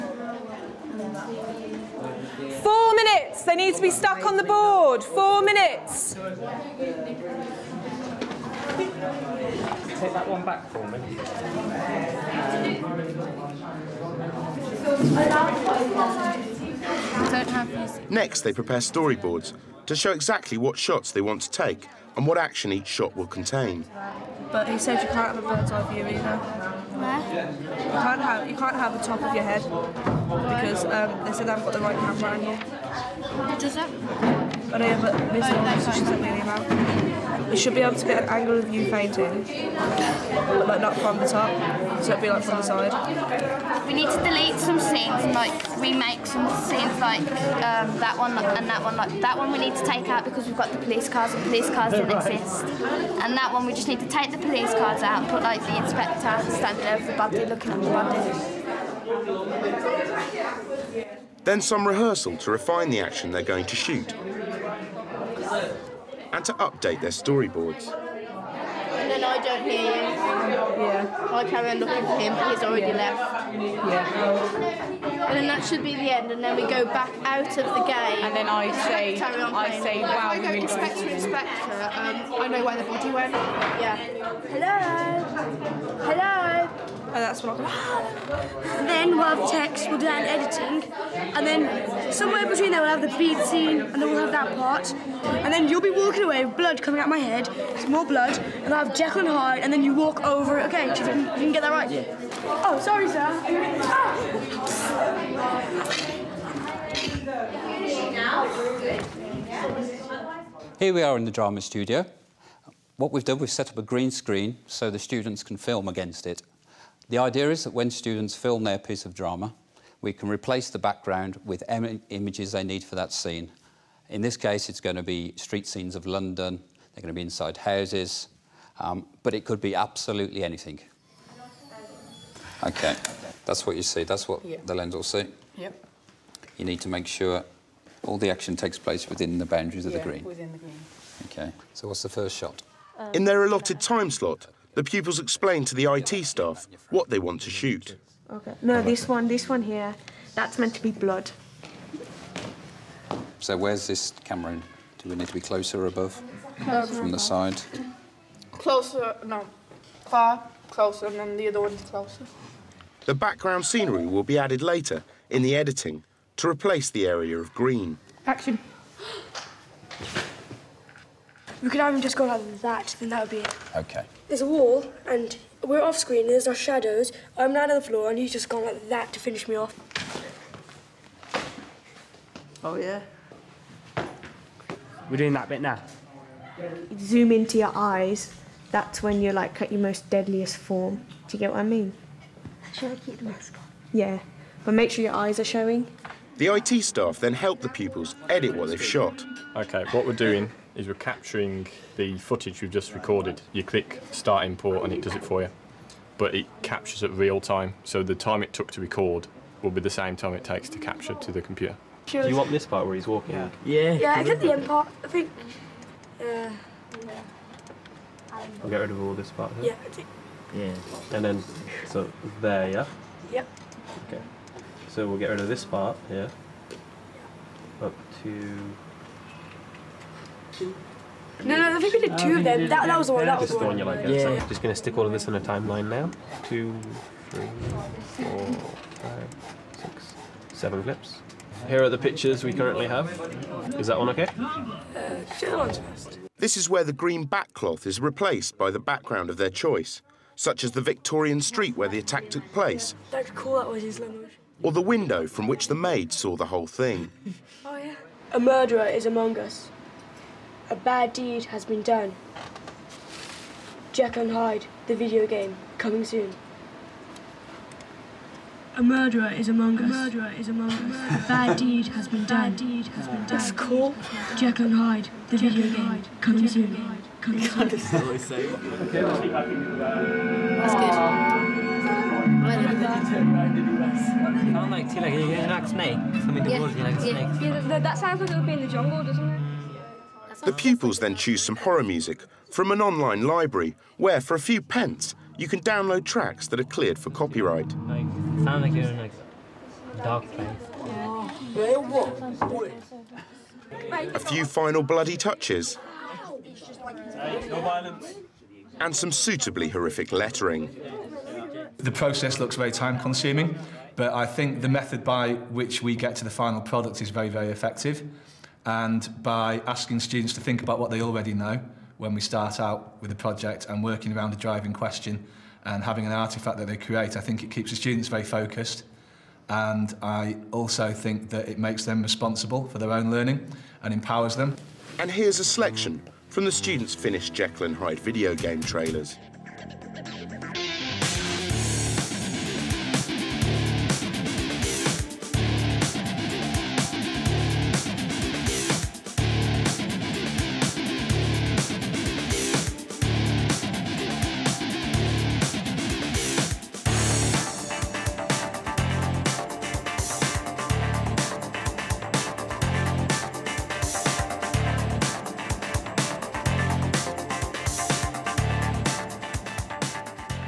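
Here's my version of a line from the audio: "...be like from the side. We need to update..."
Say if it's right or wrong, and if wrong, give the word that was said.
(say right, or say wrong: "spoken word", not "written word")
wrong: "delete", not "update".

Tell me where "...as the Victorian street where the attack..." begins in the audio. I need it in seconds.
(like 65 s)
250 s.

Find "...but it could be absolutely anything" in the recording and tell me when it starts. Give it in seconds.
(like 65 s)
129 s.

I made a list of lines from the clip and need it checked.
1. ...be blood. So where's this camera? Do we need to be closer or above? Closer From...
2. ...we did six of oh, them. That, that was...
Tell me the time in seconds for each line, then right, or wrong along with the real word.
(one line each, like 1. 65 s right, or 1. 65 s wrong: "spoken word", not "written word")
1. 150 s right
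2. 231 s wrong: "two", not "six".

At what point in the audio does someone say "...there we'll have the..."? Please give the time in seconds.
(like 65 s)
92 s.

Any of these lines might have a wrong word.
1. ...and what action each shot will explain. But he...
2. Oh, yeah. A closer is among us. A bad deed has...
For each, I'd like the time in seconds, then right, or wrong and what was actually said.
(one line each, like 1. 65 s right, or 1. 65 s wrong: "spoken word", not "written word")
1. 22 s wrong: "contain", not "explain"
2. 257 s wrong: "murderer", not "closer".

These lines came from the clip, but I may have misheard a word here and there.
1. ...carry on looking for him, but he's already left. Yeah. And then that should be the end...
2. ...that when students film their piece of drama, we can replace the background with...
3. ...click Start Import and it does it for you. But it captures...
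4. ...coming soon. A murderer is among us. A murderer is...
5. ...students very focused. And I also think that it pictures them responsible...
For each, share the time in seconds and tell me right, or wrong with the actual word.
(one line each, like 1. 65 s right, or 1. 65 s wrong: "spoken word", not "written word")
1. 71 s right
2. 117 s right
3. 203 s right
4. 265 s right
5. 327 s wrong: "makes", not "pictures".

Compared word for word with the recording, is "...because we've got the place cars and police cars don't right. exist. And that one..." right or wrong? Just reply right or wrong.
wrong.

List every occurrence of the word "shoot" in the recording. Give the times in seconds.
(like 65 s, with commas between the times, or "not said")
63 s, 147 s.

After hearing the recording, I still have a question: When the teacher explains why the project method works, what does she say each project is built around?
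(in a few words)
A driving question.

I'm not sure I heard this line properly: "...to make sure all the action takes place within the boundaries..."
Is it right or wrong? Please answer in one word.
right.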